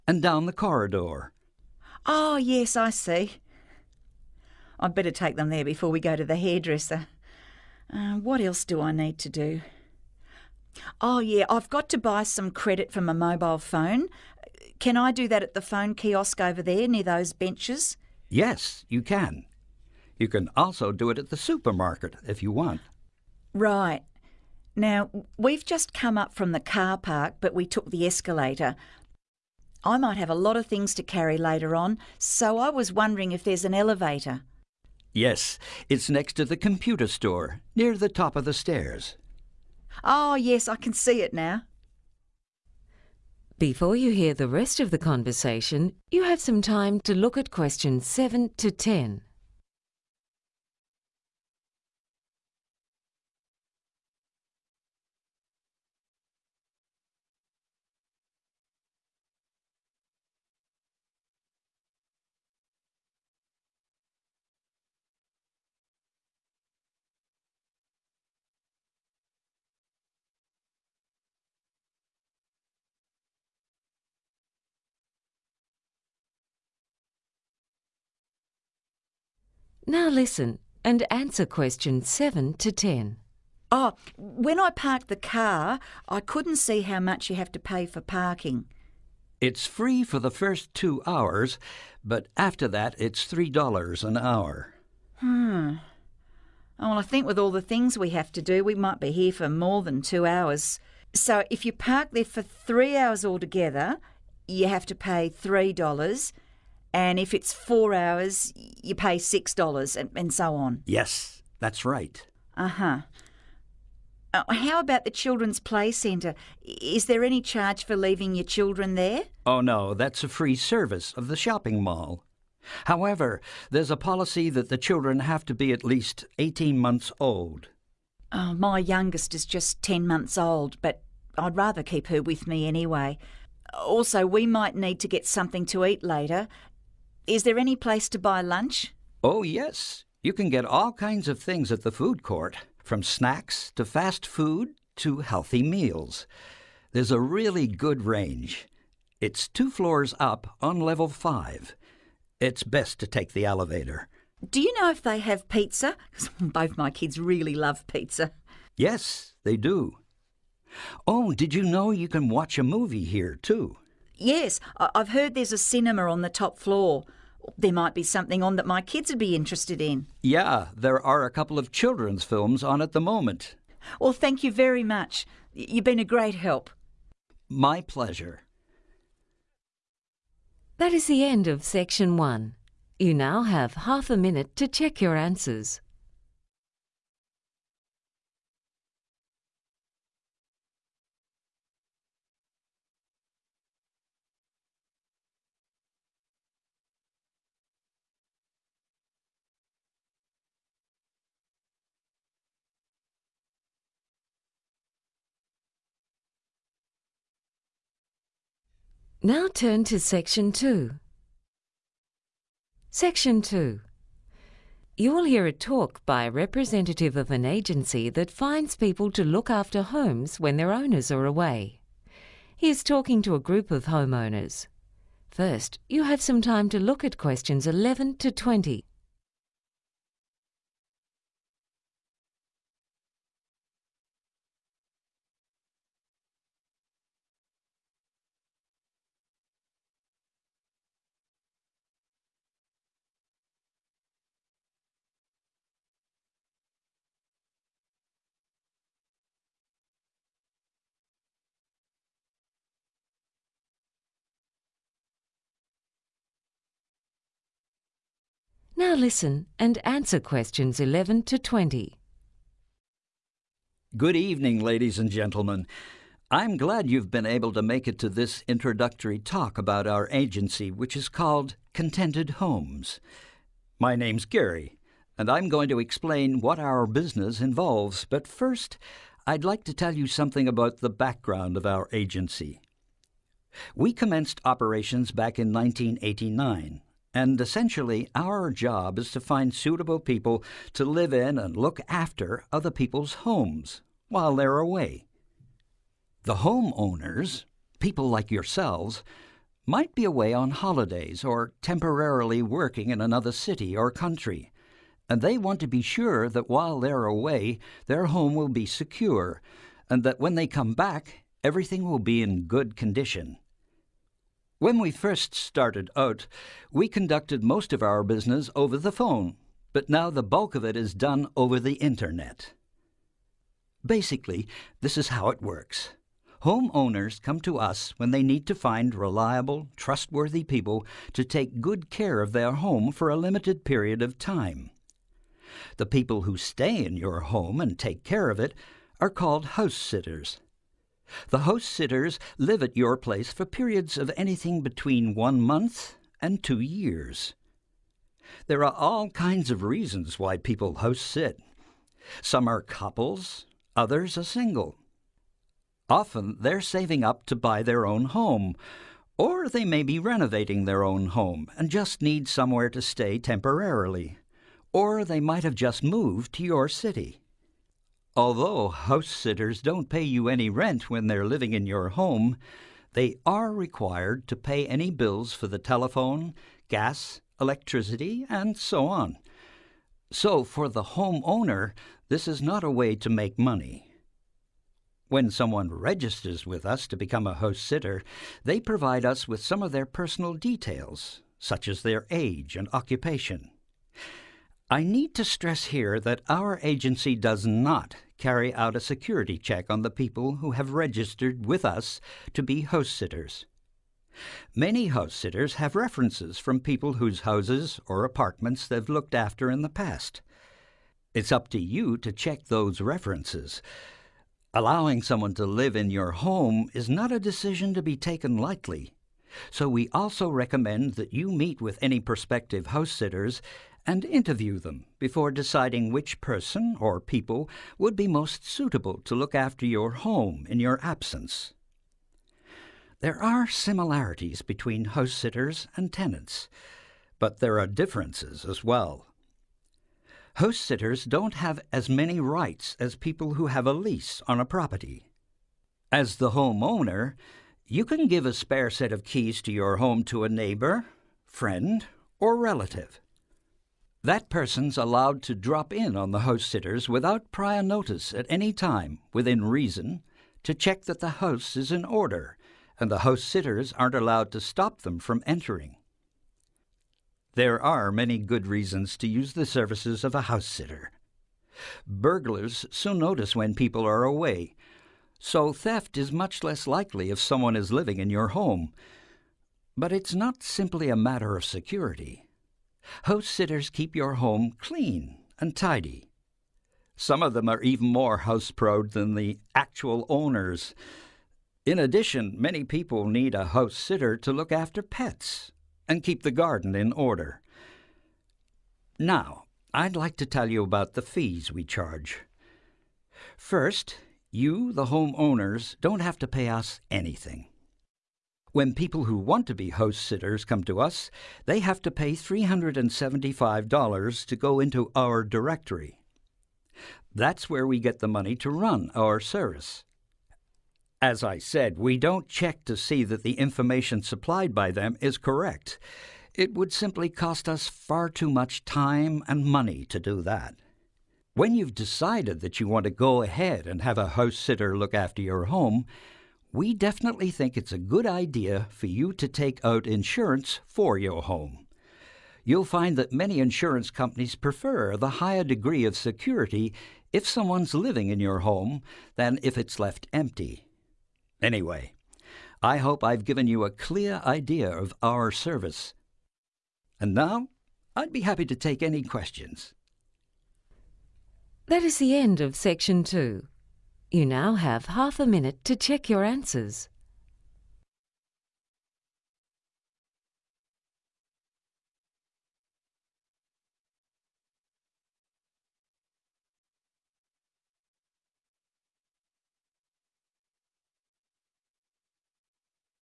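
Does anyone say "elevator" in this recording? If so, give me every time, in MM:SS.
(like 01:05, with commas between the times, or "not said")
00:33, 02:33.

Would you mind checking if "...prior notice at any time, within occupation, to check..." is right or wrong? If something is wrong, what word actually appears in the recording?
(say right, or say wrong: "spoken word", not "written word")
wrong: "reason", not "occupation".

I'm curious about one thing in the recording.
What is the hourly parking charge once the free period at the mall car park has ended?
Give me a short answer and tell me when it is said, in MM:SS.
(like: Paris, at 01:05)
$3, at 01:33.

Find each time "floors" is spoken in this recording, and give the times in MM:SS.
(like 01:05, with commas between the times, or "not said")
02:29, 02:46.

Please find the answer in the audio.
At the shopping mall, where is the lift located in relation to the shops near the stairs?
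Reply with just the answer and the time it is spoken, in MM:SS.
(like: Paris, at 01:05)
next to the computer store, at 00:36.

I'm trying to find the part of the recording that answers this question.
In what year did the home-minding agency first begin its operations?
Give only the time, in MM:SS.
04:45.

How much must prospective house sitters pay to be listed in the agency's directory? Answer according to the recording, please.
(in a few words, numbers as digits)
$375.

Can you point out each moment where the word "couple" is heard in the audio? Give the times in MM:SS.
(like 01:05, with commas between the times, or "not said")
02:51, 05:52.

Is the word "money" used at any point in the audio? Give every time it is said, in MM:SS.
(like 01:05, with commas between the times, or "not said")
06:23, 08:38, 08:49.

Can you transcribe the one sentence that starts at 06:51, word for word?
It's up to you to check those references.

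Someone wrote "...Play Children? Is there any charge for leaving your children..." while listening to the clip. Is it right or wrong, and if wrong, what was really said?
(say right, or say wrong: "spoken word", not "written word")
wrong: "Centre", not "Children".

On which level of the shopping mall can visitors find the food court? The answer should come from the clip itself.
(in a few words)
level 5.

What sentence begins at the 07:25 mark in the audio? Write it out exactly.
As the homeowner, you can give a spare set of keys to your home to a neighbor, friend, or relative.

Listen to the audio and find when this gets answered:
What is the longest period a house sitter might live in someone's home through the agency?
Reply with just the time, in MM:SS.
05:46.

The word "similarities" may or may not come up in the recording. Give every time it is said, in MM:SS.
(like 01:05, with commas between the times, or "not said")
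07:13.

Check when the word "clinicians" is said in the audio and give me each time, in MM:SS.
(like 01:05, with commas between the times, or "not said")
not said.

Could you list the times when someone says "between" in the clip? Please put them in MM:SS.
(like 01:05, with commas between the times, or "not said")
05:44, 07:14.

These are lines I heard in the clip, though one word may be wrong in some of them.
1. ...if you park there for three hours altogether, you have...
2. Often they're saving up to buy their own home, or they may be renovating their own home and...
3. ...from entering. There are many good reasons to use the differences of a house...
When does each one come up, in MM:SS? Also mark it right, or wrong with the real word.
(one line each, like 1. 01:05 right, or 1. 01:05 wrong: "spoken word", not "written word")
1. 01:41 right
2. 05:55 right
3. 07:44 wrong: "services", not "differences".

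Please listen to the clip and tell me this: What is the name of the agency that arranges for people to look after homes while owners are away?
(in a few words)
Contented Homes.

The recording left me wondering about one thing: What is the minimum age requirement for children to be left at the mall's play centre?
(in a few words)
18 months.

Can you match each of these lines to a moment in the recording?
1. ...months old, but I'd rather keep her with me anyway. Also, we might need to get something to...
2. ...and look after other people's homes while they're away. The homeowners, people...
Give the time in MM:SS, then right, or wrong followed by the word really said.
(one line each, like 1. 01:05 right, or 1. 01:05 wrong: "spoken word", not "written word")
1. 02:10 right
2. 04:51 right.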